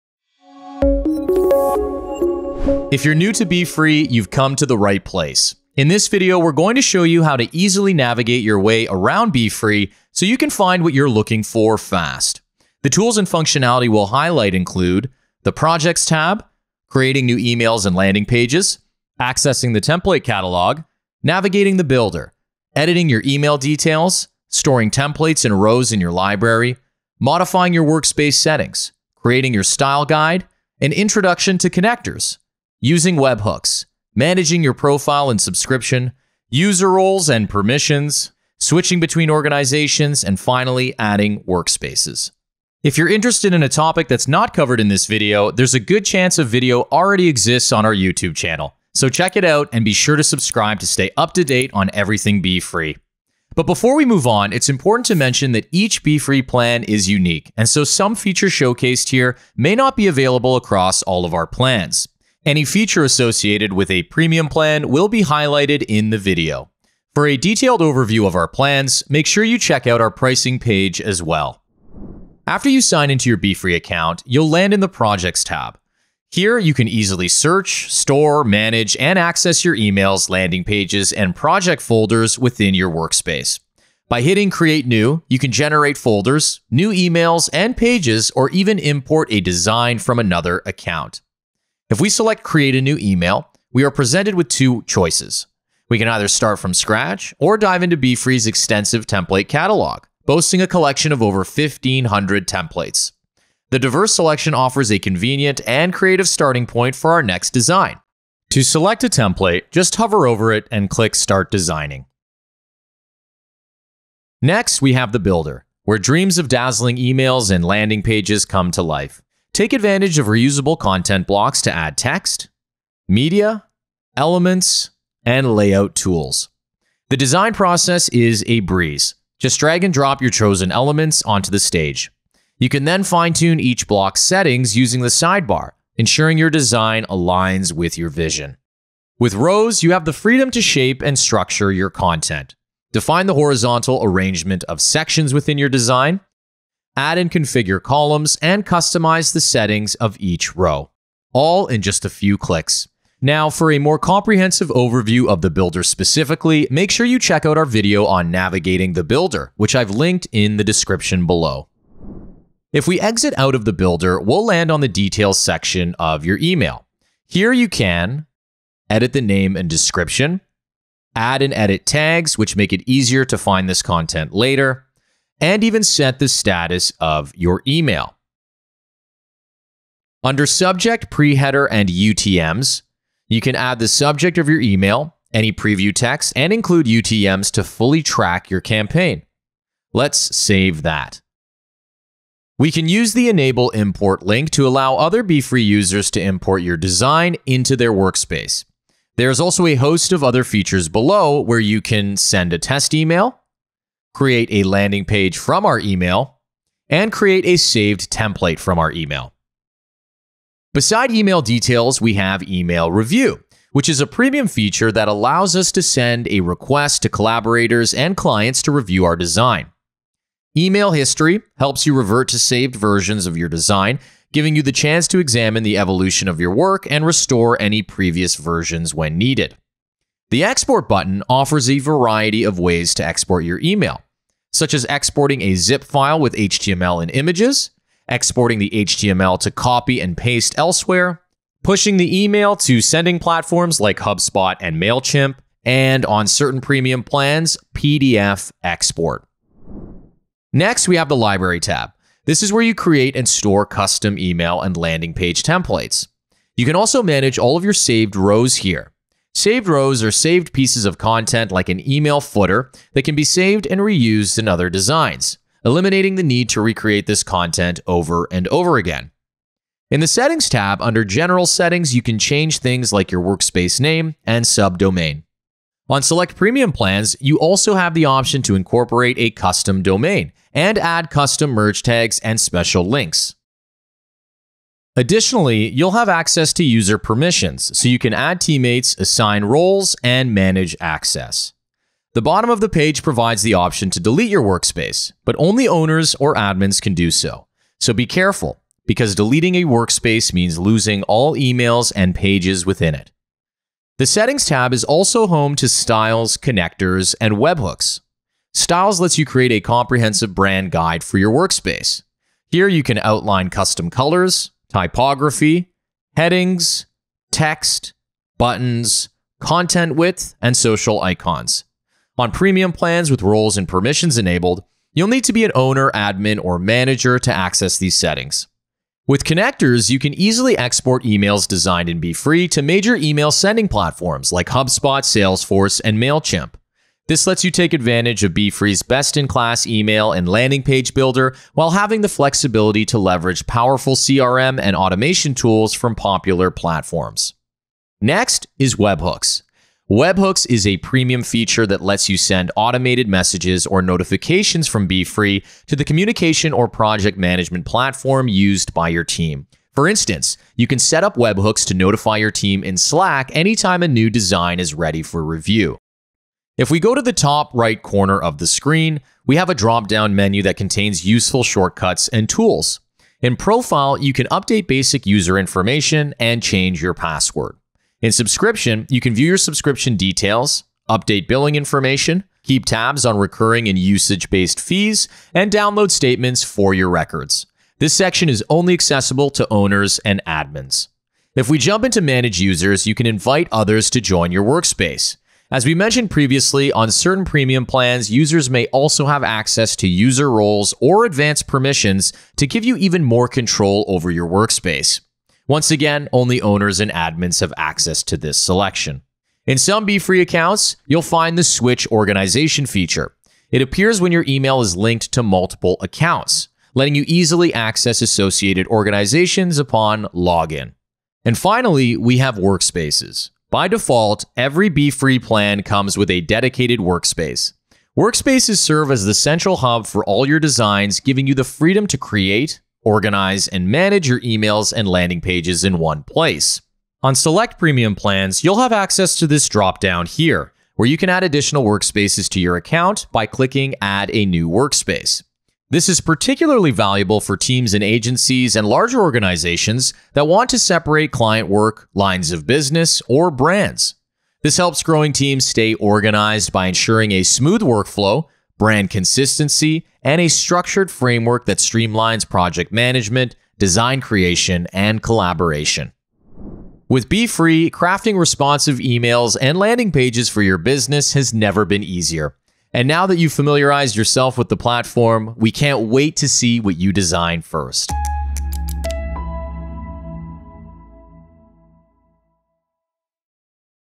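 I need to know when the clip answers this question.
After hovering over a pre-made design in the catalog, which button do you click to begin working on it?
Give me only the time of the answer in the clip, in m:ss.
1:51.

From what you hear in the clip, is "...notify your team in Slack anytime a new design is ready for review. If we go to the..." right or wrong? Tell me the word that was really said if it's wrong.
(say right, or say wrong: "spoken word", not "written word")
right.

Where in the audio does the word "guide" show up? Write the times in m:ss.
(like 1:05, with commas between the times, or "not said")
0:30, 5:10.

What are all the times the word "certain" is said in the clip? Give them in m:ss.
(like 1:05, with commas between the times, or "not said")
4:06, 6:36.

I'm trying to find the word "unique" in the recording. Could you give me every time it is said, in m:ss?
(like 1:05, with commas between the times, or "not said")
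0:57.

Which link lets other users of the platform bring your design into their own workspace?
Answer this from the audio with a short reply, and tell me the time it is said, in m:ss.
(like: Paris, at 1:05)
Enable Import, at 3:13.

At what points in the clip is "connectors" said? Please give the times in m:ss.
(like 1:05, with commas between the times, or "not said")
0:31, 5:06, 5:29.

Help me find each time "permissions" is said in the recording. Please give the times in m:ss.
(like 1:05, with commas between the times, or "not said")
0:37, 4:46, 5:23, 6:41.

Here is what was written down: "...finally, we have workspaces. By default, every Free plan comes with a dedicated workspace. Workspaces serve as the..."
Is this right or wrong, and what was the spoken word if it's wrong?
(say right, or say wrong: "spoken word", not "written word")
right.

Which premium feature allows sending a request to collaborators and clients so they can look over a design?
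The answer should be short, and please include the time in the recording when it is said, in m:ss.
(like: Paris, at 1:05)
email review, at 3:32.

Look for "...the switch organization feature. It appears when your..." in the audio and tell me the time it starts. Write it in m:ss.
6:51.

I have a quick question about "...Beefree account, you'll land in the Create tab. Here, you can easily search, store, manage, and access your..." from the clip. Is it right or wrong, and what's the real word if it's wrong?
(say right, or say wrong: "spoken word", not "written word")
wrong: "Projects", not "Create".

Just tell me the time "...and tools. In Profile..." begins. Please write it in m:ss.
6:12.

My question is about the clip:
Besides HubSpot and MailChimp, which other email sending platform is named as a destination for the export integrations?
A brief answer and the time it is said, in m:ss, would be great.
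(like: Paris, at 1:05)
Salesforce, at 5:35.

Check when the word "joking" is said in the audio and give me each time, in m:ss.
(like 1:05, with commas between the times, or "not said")
not said.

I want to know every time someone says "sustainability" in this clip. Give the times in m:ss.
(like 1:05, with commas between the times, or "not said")
not said.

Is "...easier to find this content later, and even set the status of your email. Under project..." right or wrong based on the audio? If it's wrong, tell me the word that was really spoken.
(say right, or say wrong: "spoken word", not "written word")
wrong: "subject", not "project".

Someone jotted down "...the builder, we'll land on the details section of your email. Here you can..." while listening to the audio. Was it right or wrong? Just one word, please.
right.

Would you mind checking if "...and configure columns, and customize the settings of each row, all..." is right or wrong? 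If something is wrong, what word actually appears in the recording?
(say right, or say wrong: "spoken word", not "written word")
right.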